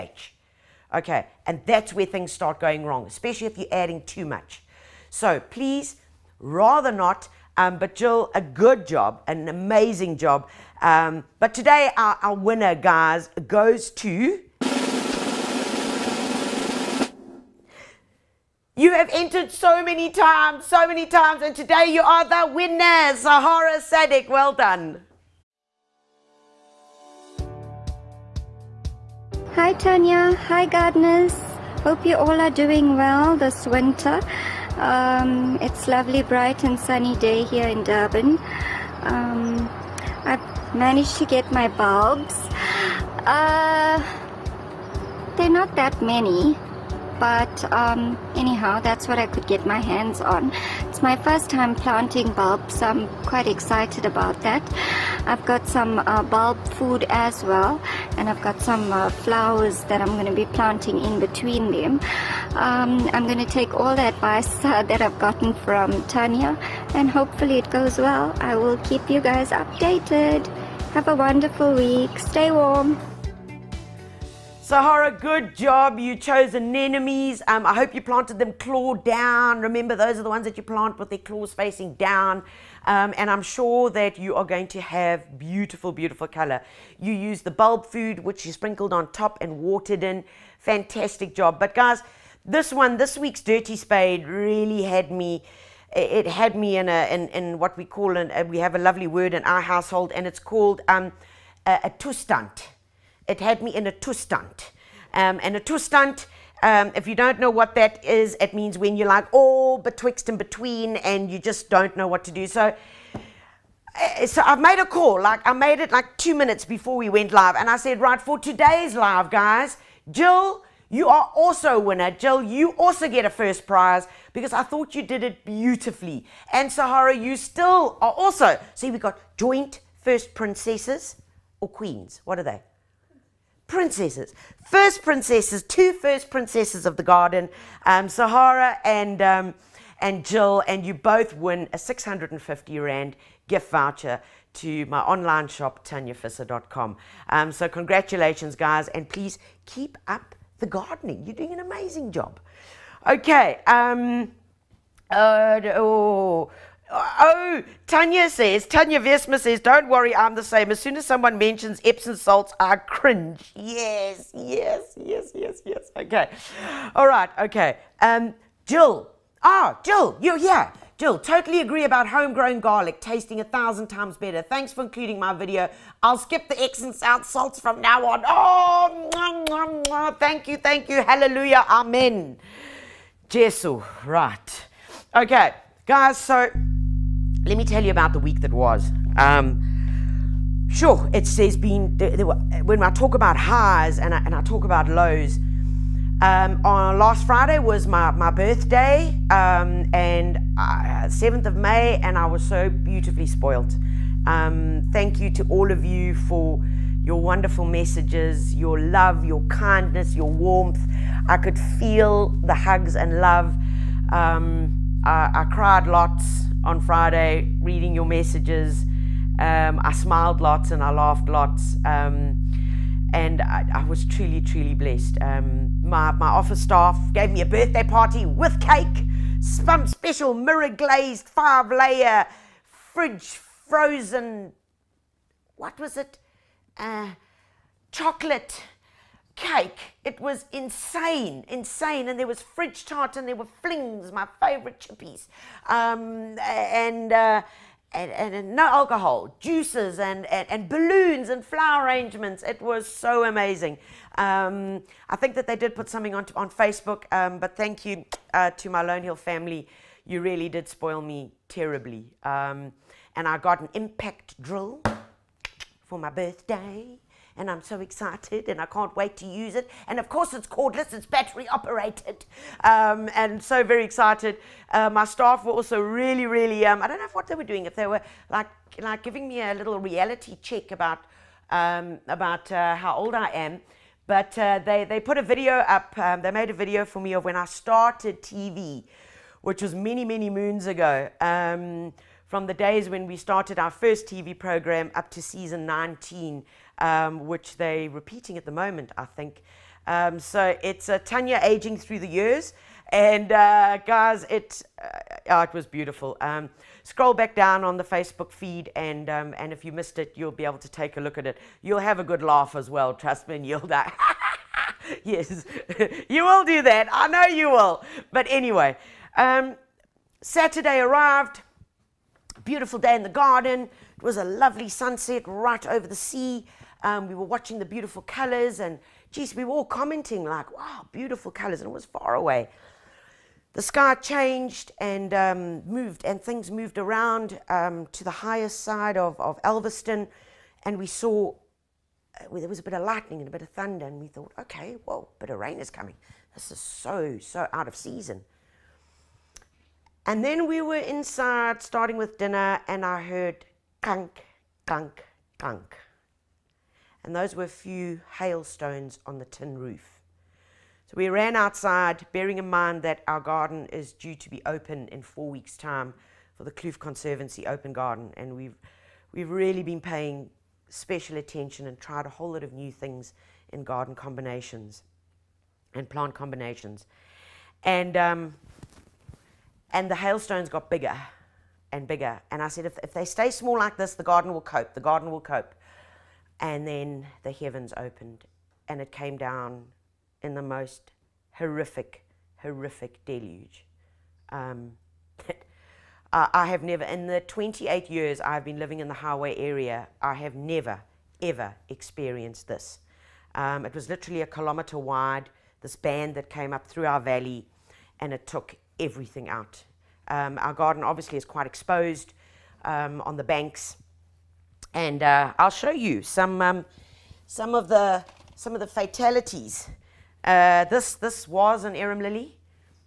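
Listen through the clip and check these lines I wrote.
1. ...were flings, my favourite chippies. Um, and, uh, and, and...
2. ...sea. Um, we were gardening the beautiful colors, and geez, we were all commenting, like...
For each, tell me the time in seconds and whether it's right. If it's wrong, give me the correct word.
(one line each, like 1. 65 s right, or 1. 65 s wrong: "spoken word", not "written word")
1. 243 s right
2. 325 s wrong: "watching", not "gardening".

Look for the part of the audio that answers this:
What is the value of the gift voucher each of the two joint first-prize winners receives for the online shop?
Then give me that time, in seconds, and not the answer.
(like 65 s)
141 s.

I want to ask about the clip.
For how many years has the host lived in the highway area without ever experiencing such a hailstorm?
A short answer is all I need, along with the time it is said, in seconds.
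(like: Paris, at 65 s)
28, at 397 s.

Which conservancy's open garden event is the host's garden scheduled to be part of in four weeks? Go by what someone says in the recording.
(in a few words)
Kloof Conservancy.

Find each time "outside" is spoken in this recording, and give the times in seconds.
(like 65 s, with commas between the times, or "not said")
361 s.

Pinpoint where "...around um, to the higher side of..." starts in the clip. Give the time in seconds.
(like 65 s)
336 s.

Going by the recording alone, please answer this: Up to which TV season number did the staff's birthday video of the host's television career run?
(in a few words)
Season 19.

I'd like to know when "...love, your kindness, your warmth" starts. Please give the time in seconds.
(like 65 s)
208 s.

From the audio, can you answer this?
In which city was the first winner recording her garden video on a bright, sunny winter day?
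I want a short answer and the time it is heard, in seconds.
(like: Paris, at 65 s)
Durban, at 37 s.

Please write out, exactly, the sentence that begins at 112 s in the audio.
So, eh, so I've made a call, like I made it like two minutes before we went live.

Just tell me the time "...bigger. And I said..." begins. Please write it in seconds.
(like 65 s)
381 s.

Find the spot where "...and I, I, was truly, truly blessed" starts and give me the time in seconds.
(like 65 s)
223 s.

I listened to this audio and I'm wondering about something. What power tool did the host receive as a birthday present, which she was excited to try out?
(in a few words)
Impact drill.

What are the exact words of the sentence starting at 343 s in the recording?
And we thought, okay, well, a bit of rain is coming.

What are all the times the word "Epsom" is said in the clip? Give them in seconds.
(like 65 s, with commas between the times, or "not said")
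161 s.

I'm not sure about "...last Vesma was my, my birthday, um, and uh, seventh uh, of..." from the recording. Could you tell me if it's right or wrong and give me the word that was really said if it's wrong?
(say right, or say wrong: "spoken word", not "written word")
wrong: "Friday", not "Vesma".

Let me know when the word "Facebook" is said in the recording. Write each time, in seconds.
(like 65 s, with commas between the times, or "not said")
256 s, 307 s.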